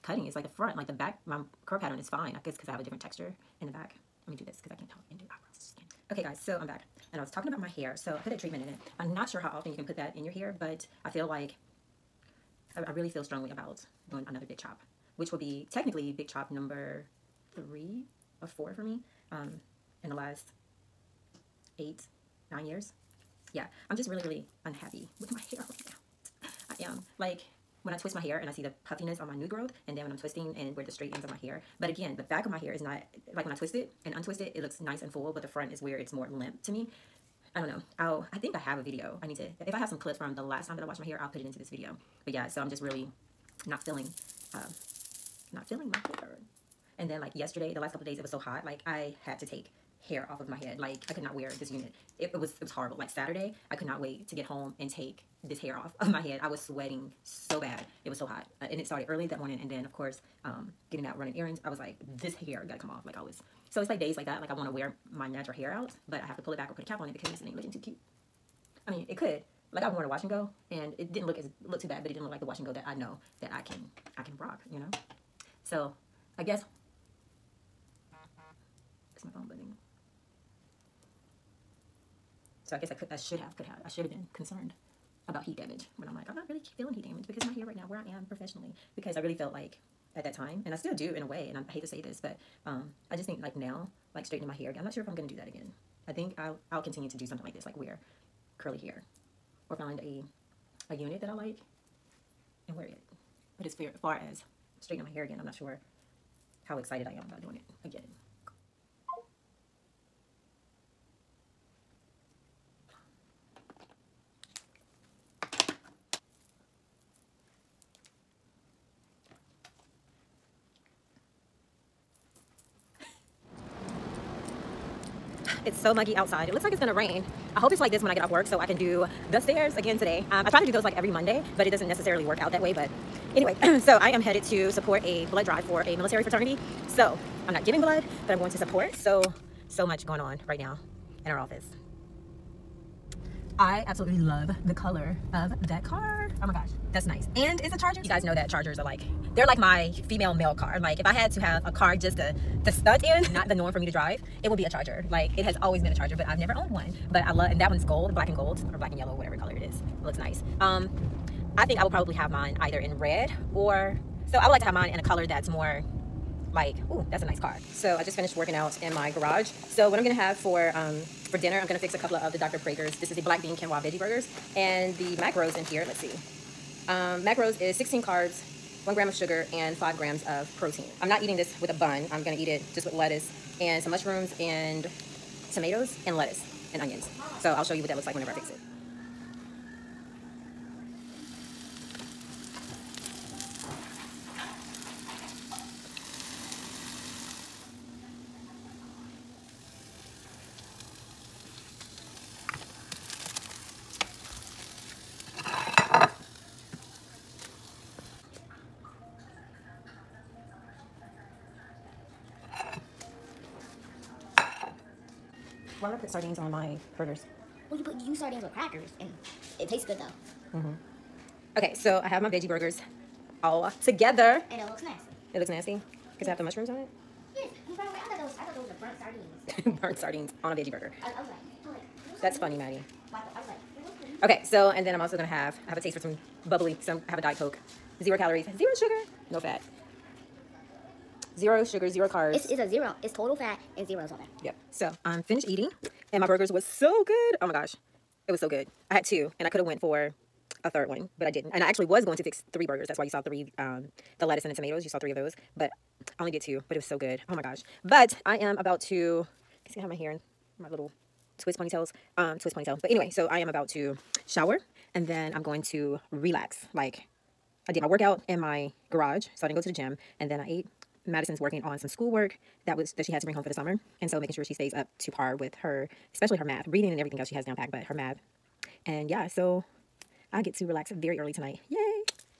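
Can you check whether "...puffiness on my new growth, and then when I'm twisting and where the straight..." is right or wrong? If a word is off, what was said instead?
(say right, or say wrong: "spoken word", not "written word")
right.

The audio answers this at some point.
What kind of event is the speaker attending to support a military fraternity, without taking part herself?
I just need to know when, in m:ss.
2:15.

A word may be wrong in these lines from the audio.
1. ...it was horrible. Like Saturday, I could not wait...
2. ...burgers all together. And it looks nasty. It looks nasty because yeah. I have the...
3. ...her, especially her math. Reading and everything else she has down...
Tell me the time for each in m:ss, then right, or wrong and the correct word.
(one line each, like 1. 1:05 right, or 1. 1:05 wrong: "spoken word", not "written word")
1. 0:52 right
2. 3:42 right
3. 4:35 right.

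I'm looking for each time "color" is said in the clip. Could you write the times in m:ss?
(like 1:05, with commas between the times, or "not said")
2:24, 2:39, 2:45.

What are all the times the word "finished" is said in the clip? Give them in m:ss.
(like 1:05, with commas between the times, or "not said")
2:48, 4:05.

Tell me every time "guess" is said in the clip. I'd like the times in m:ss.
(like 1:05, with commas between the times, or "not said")
0:02, 1:16, 1:22.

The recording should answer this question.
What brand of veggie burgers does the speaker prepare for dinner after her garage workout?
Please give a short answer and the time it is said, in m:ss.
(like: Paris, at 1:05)
Dr. Praeger's, at 2:52.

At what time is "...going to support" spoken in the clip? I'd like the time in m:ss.
2:18.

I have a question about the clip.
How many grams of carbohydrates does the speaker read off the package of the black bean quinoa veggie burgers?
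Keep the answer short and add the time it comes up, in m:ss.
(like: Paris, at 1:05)
16, at 2:57.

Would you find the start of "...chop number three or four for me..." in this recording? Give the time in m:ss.
0:16.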